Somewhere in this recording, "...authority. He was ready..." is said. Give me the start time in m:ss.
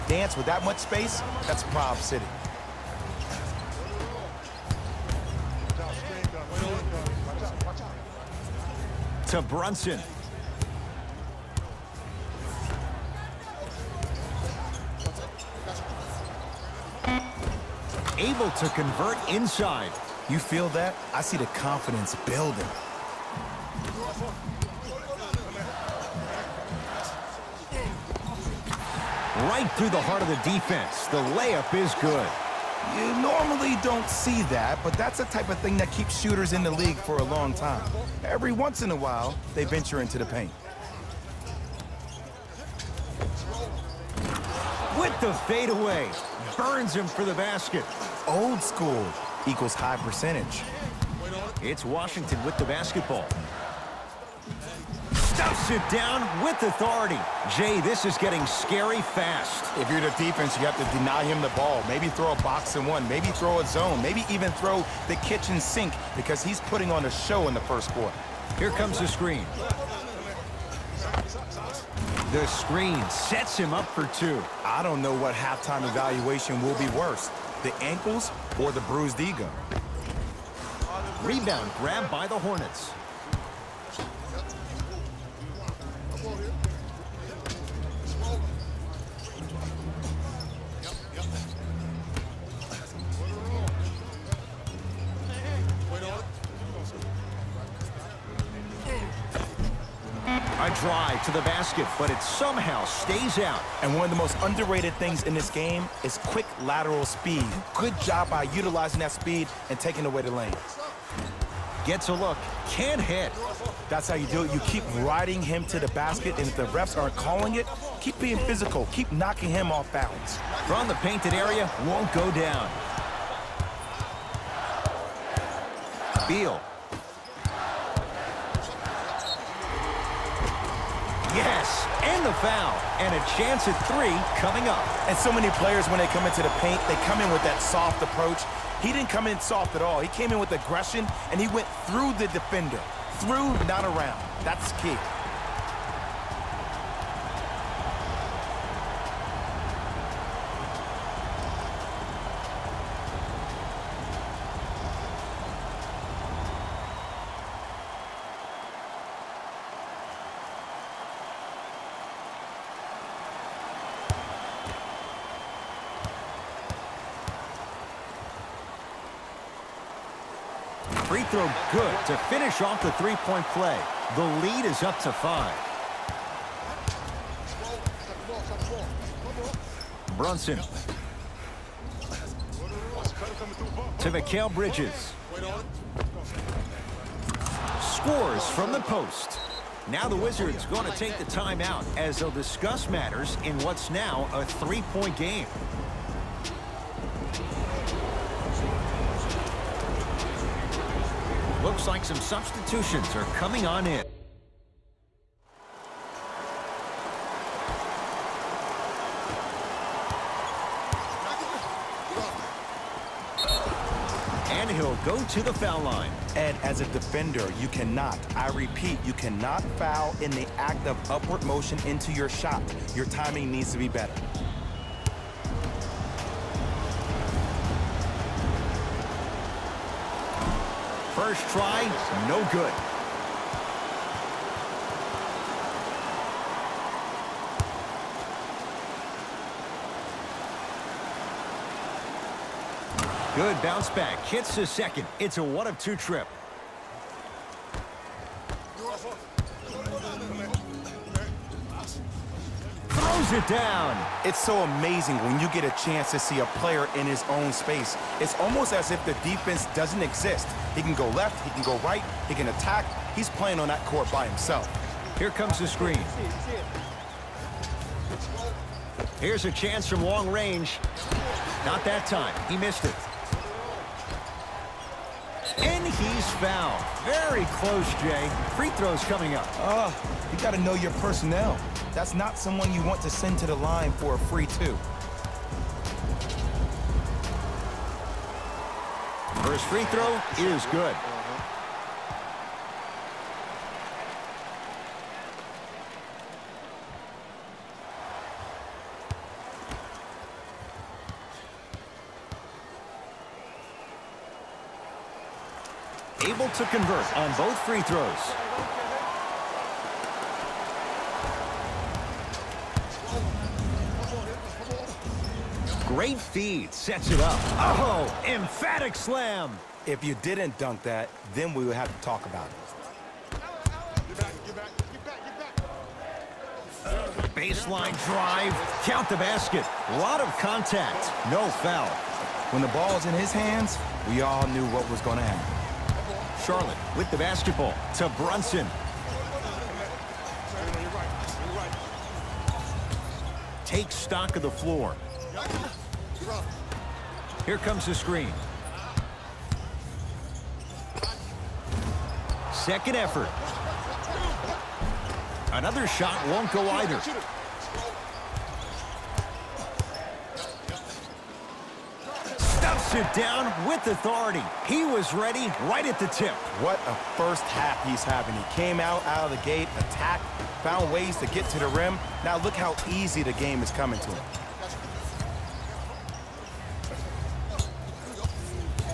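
6:03.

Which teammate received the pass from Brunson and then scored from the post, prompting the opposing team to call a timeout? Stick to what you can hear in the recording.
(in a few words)
Mikal Bridges.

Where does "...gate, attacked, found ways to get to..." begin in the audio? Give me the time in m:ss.
6:09.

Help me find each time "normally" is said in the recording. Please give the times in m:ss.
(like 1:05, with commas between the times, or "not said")
0:33.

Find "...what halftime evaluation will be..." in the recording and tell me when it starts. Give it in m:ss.
1:15.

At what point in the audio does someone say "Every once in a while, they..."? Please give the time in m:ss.
0:38.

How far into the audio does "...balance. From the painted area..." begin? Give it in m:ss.
1:59.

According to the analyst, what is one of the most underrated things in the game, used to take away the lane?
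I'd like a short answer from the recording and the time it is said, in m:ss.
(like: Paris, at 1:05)
Quick lateral speed, at 1:46.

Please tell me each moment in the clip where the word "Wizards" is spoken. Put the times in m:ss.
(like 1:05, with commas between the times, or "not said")
3:10.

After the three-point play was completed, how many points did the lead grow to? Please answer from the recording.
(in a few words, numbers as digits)
5.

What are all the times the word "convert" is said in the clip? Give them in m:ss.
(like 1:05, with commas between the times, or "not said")
0:18, 5:06.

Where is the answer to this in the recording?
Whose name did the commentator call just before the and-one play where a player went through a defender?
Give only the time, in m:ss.
2:06.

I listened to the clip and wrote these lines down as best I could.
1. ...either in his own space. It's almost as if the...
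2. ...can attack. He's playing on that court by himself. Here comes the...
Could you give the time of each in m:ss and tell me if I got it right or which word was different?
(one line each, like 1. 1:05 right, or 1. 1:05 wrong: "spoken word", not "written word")
1. 4:16 wrong: "player", not "either"
2. 4:22 right.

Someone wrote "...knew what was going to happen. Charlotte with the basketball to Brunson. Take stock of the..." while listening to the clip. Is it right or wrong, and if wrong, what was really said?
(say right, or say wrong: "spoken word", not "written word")
right.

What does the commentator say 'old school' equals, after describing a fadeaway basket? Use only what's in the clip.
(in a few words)
High percentage.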